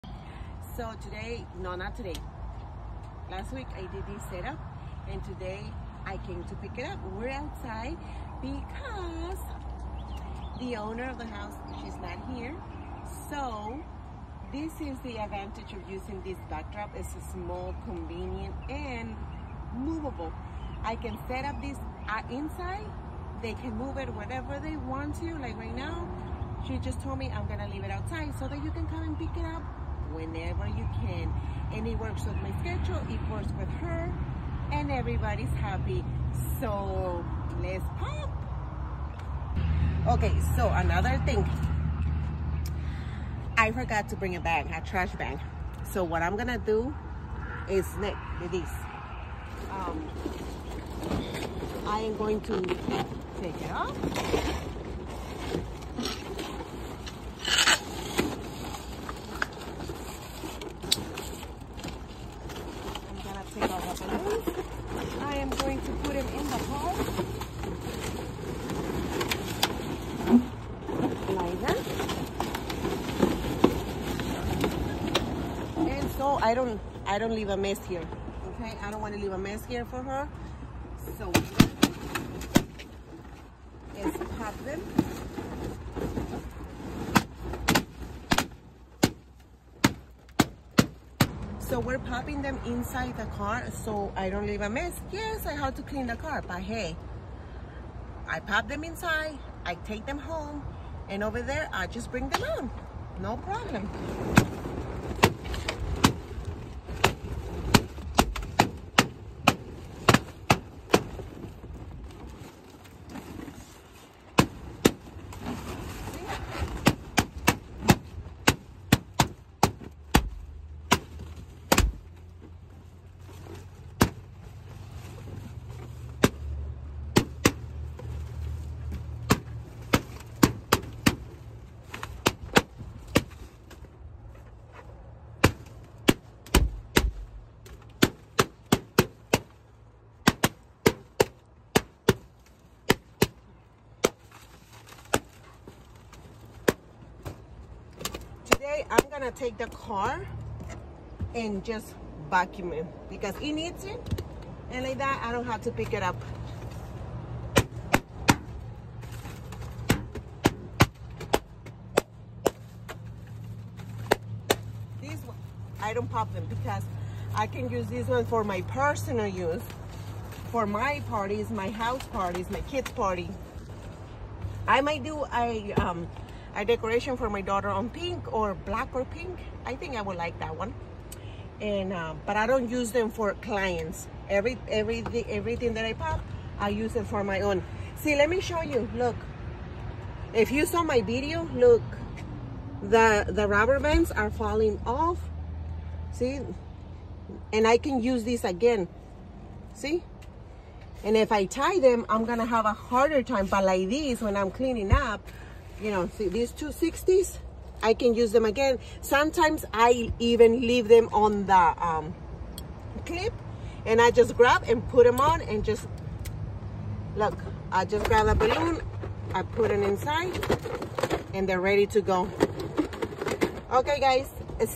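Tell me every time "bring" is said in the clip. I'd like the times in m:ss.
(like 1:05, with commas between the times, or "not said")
0:44, 1:42.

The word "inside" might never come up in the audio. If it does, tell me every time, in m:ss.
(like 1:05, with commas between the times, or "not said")
0:22, 1:32, 1:38, 3:39.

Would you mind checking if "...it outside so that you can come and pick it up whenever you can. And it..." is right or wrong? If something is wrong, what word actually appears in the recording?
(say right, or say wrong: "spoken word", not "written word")
right.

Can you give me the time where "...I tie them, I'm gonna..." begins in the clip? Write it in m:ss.
3:21.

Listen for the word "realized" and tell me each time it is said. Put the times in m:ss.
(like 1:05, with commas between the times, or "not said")
not said.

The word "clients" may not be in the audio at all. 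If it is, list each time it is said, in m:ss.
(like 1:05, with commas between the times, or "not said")
3:03.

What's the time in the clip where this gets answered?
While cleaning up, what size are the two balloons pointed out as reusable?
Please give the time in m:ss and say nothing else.
3:26.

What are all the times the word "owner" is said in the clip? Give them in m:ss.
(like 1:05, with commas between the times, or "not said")
0:10.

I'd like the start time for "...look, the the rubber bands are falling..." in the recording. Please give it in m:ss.
3:11.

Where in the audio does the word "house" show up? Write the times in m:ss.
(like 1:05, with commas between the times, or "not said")
0:11, 2:51.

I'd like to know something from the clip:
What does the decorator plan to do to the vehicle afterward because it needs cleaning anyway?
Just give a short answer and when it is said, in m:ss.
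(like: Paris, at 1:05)
vacuum it, at 2:32.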